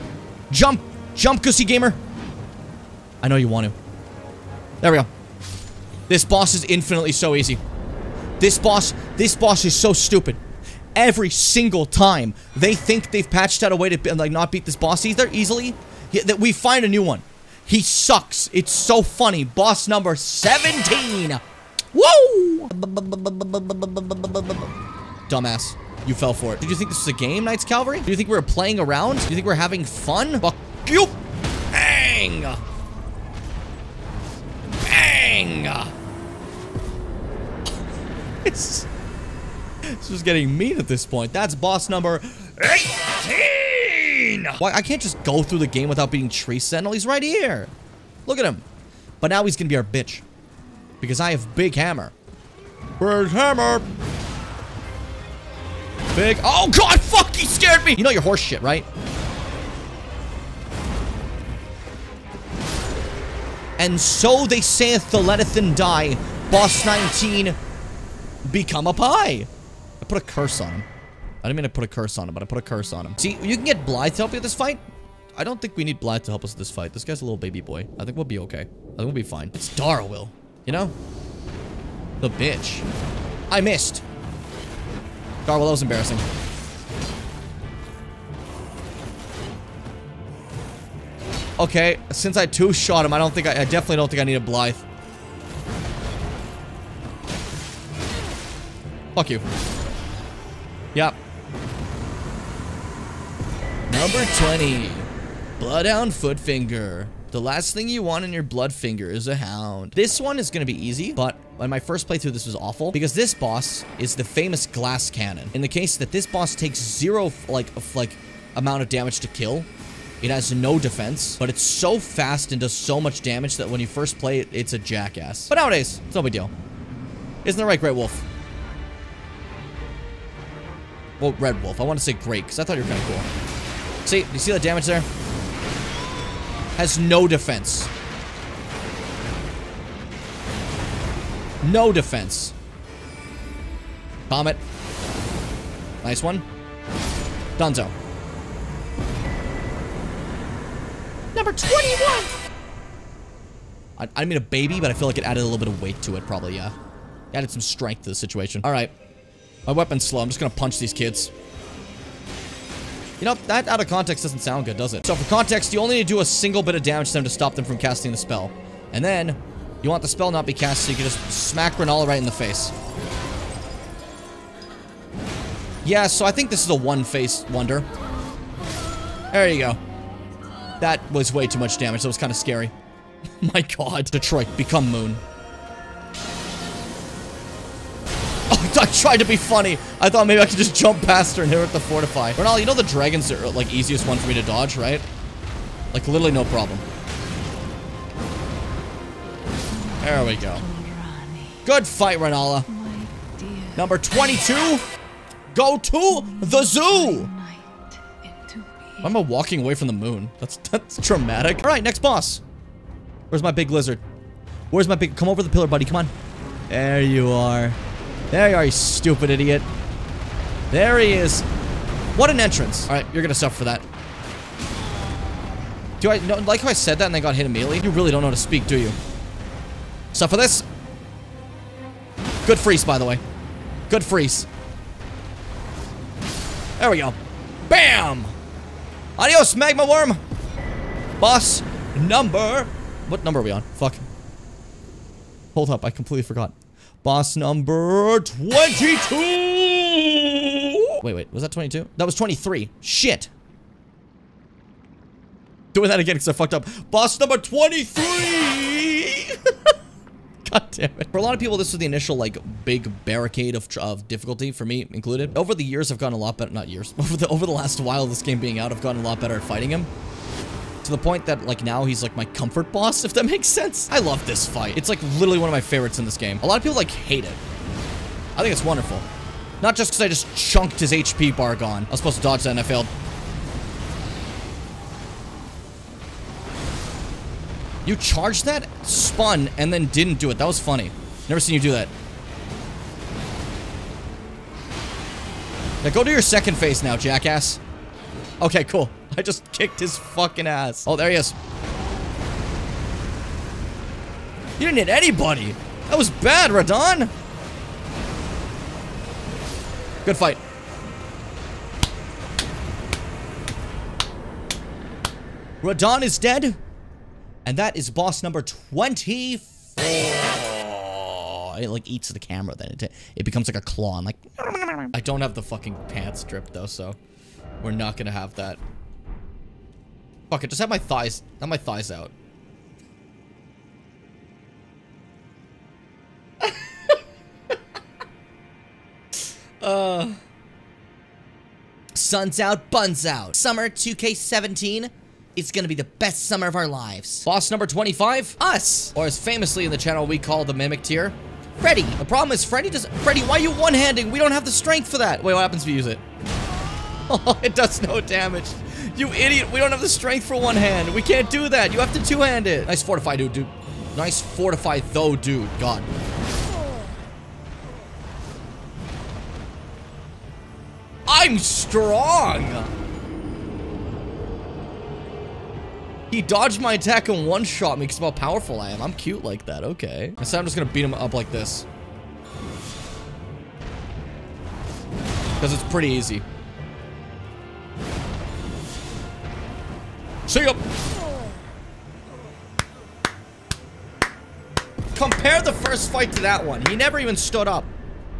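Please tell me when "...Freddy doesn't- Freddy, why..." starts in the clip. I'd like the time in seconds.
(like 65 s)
352 s.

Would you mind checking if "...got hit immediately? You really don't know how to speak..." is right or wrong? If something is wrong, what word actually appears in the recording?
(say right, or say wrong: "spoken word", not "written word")
right.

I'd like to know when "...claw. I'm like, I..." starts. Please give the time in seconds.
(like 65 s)
323 s.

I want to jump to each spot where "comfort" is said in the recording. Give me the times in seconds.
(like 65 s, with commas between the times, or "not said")
272 s.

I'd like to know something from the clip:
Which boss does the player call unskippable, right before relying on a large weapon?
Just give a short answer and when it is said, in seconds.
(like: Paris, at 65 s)
Tree Sentinel, at 46 s.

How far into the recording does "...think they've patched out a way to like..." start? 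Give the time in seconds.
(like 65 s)
12 s.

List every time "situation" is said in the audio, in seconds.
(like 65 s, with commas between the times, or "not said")
158 s.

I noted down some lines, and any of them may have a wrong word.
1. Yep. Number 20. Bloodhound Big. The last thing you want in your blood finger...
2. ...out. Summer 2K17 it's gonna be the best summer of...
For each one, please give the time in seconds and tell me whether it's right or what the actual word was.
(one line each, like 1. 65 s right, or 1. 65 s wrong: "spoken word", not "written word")
1. 100 s wrong: "Footfinger", not "Big"
2. 343 s right.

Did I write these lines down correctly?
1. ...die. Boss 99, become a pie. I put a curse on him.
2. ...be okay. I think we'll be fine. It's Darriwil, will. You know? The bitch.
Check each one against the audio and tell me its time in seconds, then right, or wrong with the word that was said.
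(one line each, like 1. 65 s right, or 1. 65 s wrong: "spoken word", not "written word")
1. 65 s wrong: "19", not "99"
2. 78 s right.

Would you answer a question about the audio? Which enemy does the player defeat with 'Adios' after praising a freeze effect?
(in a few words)
magma wyrm.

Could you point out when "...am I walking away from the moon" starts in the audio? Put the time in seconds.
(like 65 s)
209 s.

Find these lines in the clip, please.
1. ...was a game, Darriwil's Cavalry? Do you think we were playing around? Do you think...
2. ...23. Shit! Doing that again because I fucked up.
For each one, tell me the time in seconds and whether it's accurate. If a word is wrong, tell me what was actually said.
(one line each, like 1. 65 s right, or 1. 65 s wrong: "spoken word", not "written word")
1. 26 s wrong: "Night", not "Darriwil"
2. 252 s right.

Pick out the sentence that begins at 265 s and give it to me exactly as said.
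Over the years, I've gotten a lot better- not years.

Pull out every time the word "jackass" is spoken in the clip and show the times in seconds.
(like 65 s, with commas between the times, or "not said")
124 s, 296 s.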